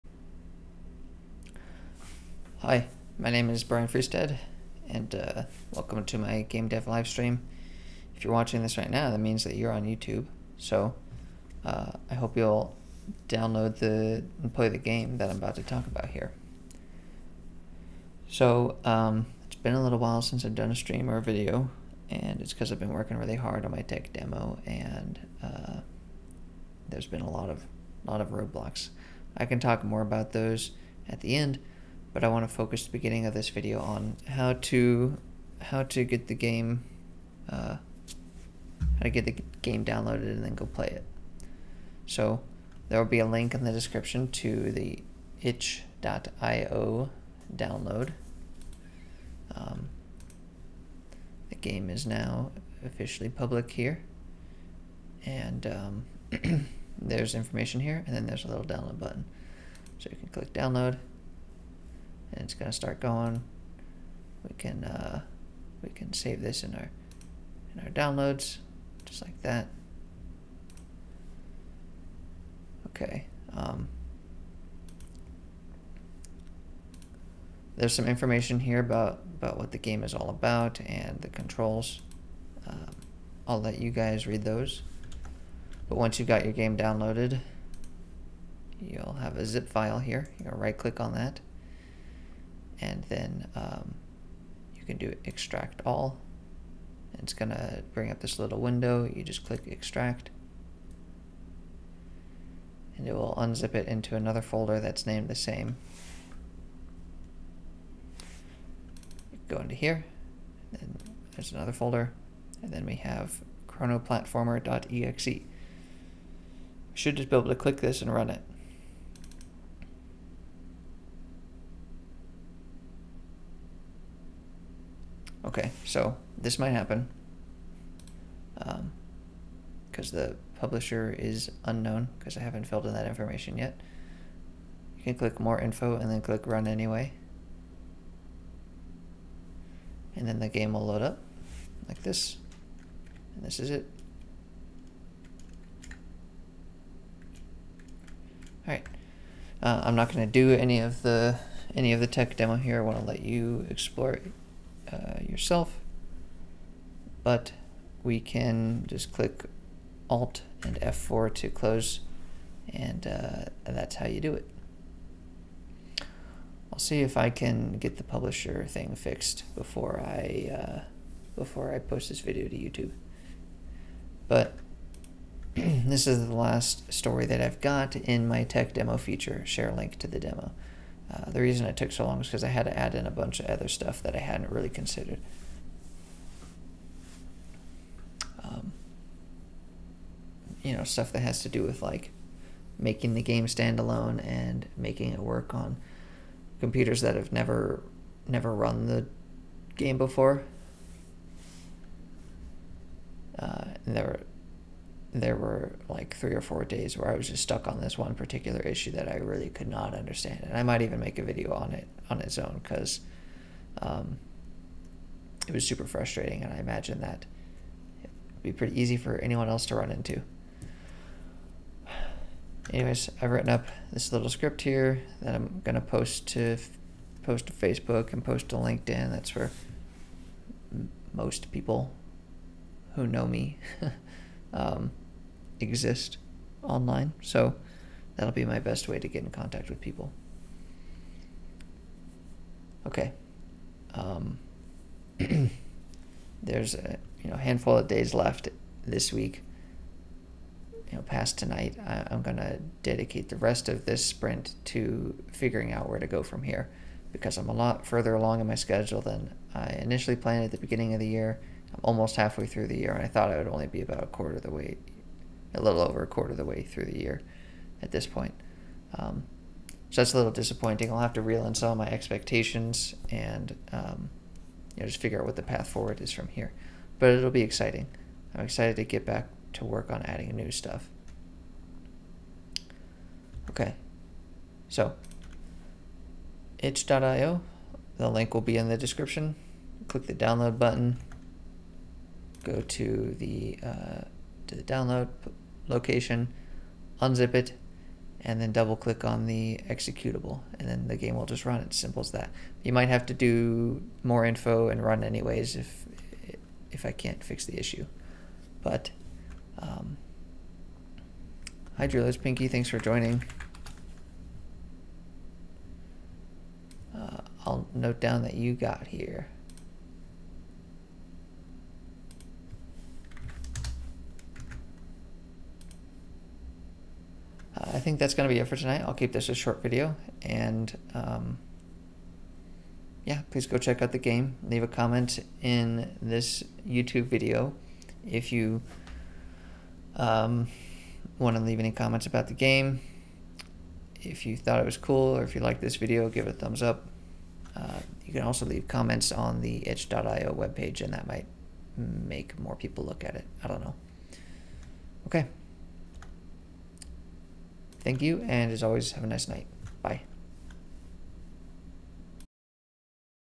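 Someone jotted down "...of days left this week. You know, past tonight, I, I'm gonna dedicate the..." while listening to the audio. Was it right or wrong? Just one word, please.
right.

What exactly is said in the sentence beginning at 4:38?
I'm excited to get back to work on adding new stuff.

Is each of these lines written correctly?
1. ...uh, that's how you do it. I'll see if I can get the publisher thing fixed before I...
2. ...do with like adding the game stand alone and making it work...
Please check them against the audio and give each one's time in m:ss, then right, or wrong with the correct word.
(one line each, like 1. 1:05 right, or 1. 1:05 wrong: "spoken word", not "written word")
1. 2:43 right
2. 3:11 wrong: "making", not "adding".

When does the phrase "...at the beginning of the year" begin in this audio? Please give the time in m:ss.
4:20.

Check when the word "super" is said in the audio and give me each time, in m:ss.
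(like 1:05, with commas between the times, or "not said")
3:35.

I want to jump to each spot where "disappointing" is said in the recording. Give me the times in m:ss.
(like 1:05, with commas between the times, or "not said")
4:30.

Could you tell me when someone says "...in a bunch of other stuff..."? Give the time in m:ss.
3:02.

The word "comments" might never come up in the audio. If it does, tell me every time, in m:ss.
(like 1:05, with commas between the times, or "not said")
5:34, 5:41, 5:48.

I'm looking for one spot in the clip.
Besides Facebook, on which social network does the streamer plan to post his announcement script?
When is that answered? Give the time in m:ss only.
3:48.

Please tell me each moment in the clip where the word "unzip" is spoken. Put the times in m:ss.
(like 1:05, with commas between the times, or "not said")
1:43, 4:57.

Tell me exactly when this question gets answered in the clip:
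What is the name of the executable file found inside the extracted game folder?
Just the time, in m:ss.
1:53.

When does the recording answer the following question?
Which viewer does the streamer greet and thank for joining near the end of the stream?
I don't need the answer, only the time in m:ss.
5:11.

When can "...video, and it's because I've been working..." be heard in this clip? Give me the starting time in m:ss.
0:21.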